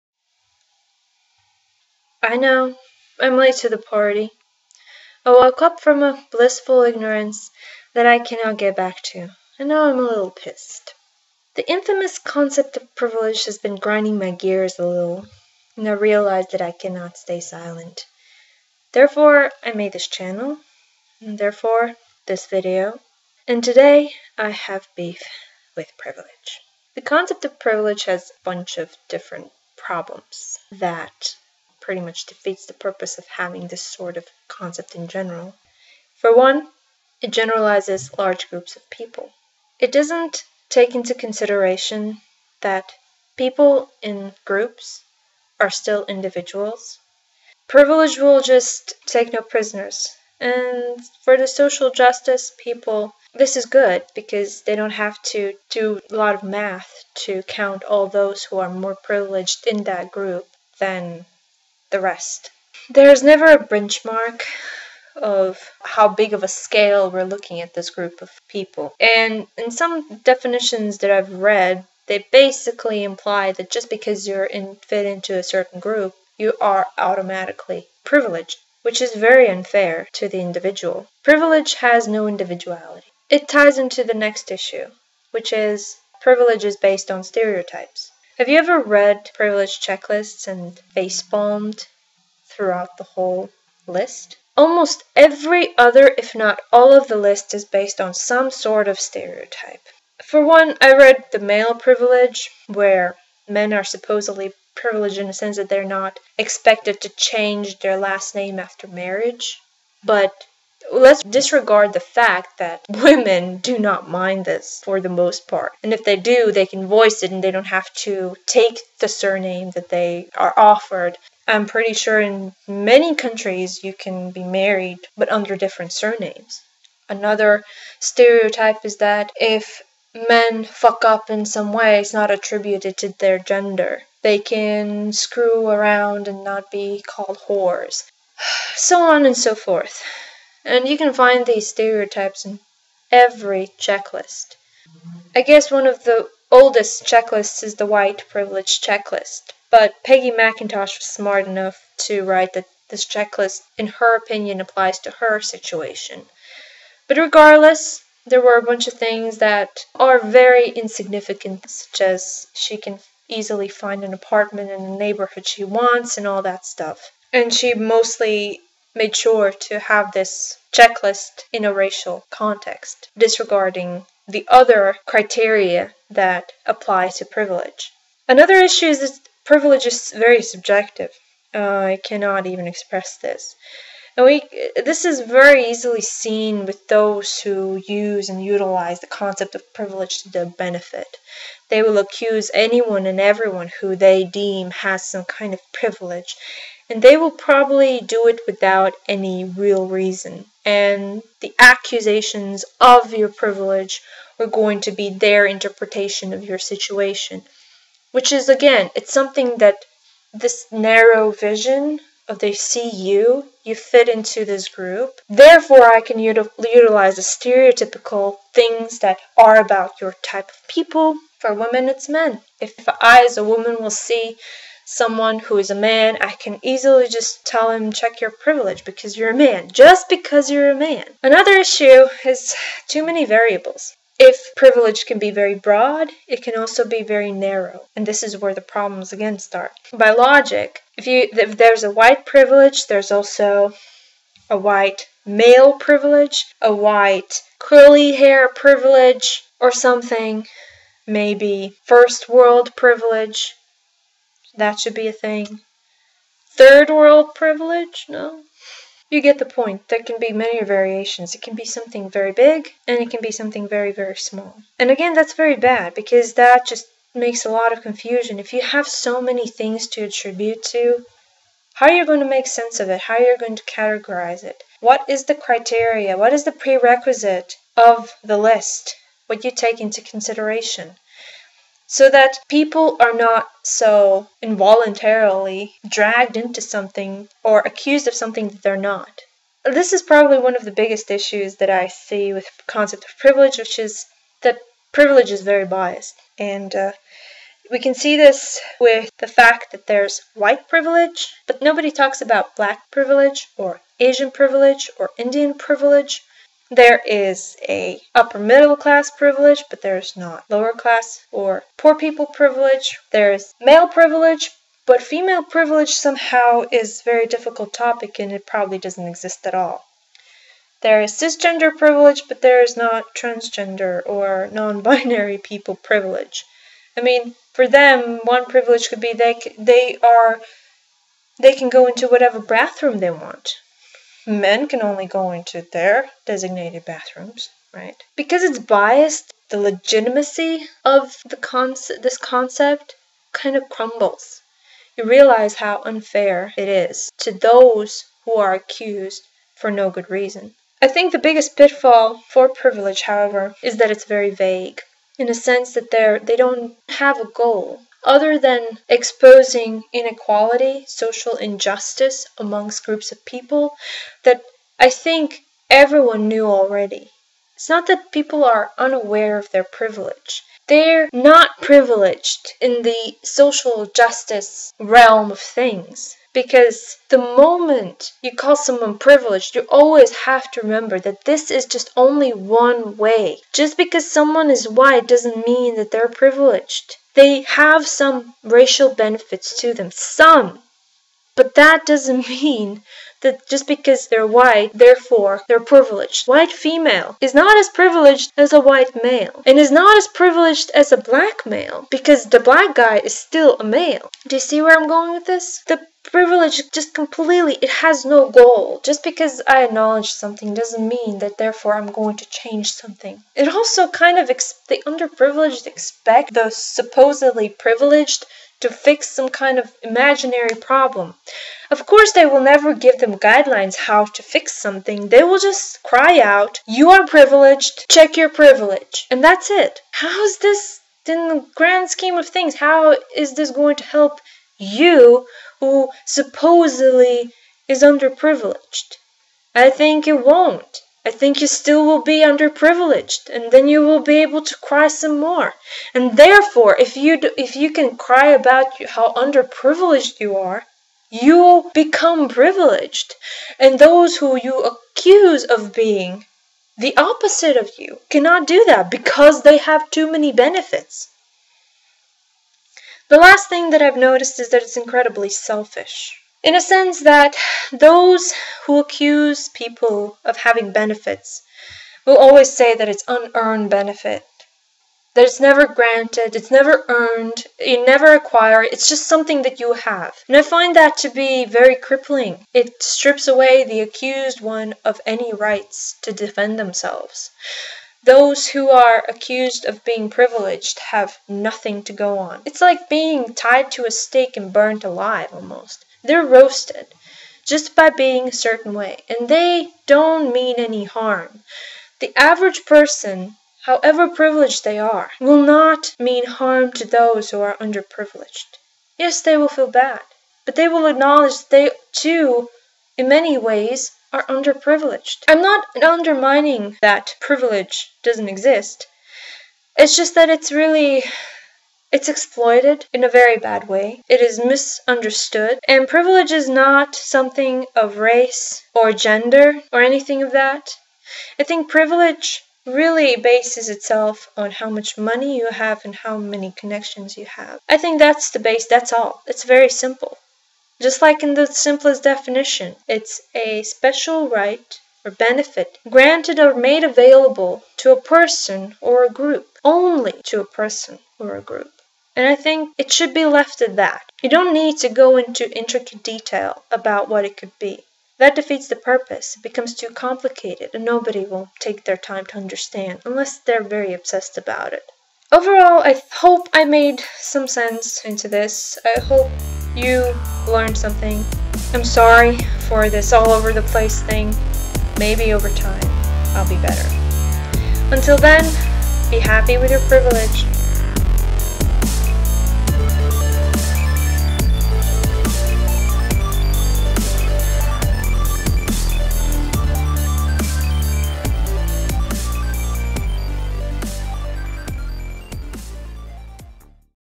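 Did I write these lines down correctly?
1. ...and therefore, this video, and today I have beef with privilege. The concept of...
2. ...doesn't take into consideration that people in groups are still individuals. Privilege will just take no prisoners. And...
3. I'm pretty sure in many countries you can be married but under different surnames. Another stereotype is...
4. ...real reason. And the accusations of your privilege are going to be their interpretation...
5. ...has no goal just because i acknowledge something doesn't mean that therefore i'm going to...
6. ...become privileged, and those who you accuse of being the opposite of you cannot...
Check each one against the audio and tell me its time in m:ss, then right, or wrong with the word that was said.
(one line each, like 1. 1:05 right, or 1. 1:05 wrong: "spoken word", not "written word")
1. 0:21 right
2. 0:39 right
3. 2:01 right
4. 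3:19 right
5. 6:47 right
6. 7:31 right.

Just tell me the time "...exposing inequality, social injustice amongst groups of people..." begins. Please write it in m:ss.
5:58.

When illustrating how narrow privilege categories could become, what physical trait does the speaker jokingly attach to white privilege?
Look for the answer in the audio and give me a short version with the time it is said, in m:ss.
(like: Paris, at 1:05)
curly hair, at 4:07.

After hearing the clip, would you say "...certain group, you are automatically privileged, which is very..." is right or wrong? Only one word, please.
right.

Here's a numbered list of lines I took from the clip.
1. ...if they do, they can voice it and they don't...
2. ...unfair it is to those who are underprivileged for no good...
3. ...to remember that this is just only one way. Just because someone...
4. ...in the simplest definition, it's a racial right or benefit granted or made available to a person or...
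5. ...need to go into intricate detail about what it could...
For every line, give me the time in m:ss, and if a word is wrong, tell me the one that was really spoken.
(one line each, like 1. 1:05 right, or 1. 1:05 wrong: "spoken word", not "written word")
1. 1:55 right
2. 5:45 wrong: "accused", not "underprivileged"
3. 6:20 right
4. 9:01 wrong: "special", not "racial"
5. 9:14 right.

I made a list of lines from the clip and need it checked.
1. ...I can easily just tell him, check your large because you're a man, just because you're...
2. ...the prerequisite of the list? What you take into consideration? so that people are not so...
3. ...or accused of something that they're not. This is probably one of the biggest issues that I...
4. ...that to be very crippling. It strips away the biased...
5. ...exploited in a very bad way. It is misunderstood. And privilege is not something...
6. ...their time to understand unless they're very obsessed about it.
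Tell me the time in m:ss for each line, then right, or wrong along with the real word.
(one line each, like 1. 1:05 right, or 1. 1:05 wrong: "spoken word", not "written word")
1. 3:46 wrong: "privilege", not "large"
2. 4:36 right
3. 4:47 right
4. 8:00 wrong: "accused", not "biased"
5. 8:42 right
6. 9:21 right.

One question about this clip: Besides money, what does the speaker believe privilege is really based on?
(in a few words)
connections.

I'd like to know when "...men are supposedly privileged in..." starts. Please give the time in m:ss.
1:43.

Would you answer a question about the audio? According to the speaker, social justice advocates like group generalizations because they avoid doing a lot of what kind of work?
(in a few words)
math.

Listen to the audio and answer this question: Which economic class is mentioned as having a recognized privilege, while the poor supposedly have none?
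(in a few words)
upper middle class.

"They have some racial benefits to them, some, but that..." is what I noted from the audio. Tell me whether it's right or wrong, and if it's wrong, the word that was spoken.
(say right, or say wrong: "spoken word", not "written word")
right.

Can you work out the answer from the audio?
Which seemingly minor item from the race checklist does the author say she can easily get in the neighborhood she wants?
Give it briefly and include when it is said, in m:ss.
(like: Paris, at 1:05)
an apartment, at 2:44.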